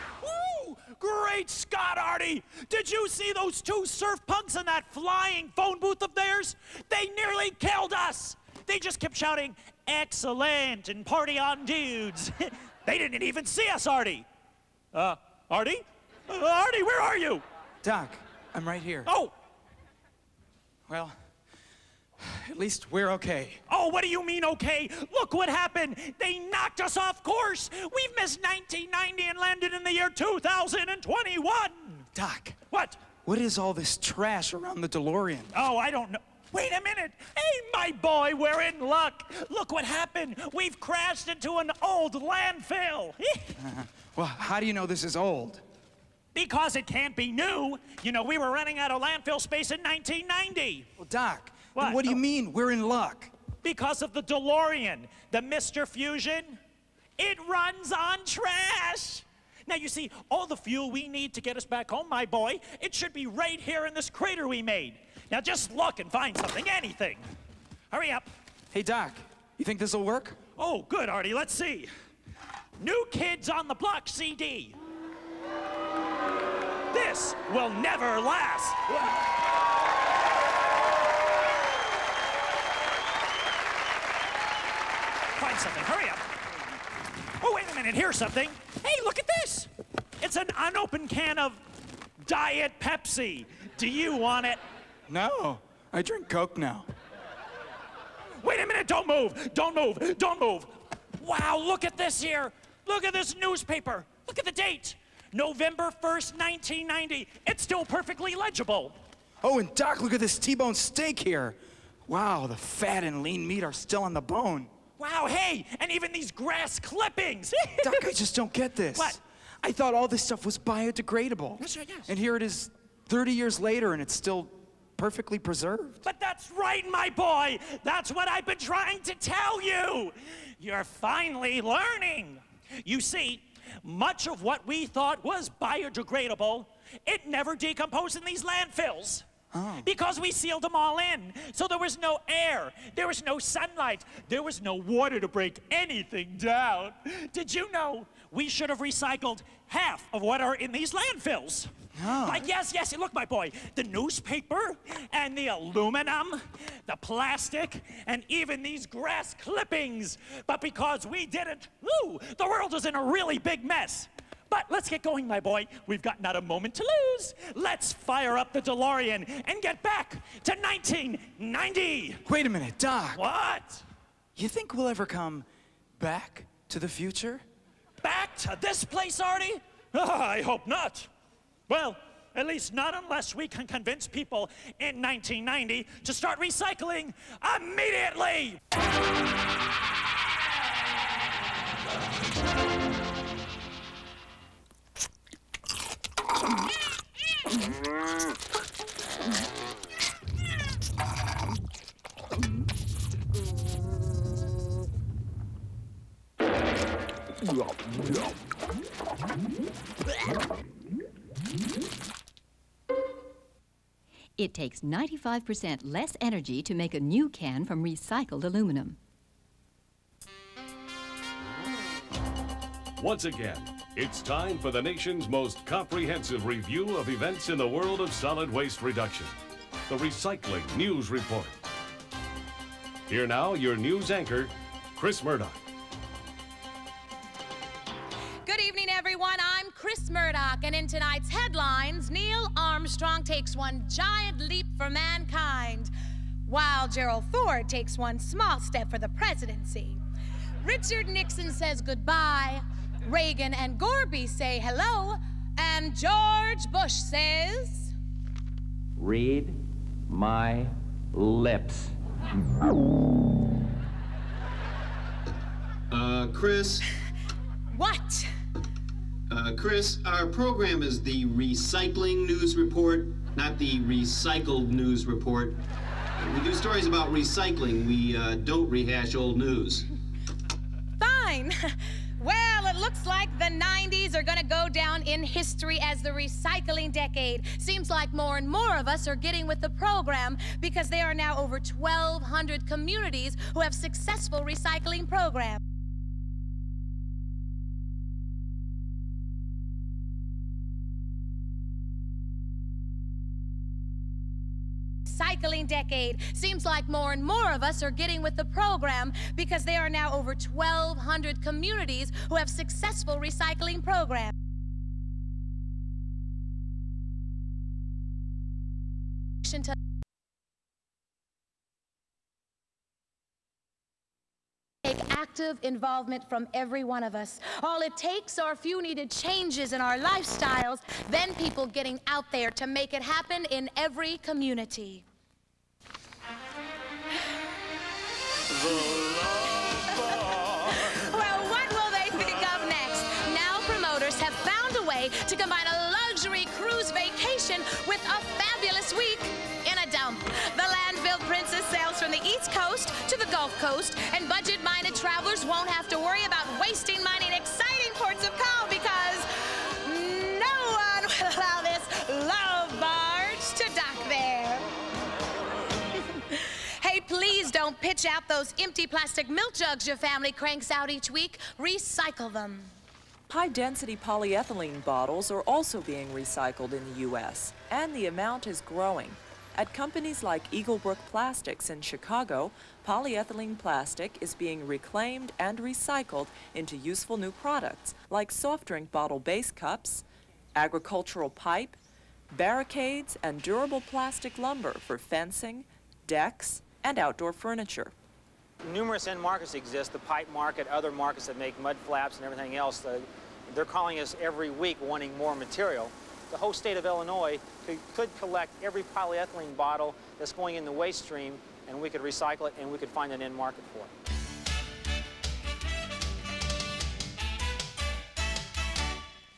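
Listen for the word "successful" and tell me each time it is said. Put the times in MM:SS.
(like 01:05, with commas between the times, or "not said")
04:53, 05:12.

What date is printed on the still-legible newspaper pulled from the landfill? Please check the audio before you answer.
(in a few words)
November 1st, 1990.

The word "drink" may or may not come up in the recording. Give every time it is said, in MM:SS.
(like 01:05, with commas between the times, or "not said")
01:36, 06:28.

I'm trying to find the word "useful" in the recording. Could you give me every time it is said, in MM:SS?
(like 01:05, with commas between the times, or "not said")
06:26.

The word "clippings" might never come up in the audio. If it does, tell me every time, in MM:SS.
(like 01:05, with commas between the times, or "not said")
01:56, 02:39.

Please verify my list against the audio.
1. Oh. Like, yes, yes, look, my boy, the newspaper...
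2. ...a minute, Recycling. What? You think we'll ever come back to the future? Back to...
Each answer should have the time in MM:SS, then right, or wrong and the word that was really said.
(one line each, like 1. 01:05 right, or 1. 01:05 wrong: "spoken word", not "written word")
1. 02:32 right
2. 02:52 wrong: "Doc", not "Recycling".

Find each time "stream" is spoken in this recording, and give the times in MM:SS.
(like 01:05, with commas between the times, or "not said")
06:51.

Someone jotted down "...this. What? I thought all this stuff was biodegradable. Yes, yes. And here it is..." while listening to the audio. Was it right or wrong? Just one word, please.
right.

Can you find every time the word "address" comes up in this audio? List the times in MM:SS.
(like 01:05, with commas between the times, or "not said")
not said.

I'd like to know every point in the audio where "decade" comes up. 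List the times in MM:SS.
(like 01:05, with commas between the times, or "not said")
04:46, 05:05.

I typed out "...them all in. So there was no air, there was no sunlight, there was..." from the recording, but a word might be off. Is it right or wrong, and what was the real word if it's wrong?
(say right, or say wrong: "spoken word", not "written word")
right.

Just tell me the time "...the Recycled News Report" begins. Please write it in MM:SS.
04:33.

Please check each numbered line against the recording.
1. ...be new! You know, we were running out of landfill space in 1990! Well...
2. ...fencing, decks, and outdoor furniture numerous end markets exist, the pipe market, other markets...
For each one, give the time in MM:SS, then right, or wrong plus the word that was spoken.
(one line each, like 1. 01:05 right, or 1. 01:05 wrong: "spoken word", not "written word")
1. 00:47 right
2. 06:34 right.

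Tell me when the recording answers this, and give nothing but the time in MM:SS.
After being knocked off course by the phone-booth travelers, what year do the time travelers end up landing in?
00:30.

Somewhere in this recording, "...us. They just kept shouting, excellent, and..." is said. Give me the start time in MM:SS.
00:07.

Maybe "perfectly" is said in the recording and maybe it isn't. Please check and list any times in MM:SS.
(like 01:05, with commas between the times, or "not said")
01:47, 02:04.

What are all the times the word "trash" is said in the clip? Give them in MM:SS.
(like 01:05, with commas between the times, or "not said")
00:33, 00:58.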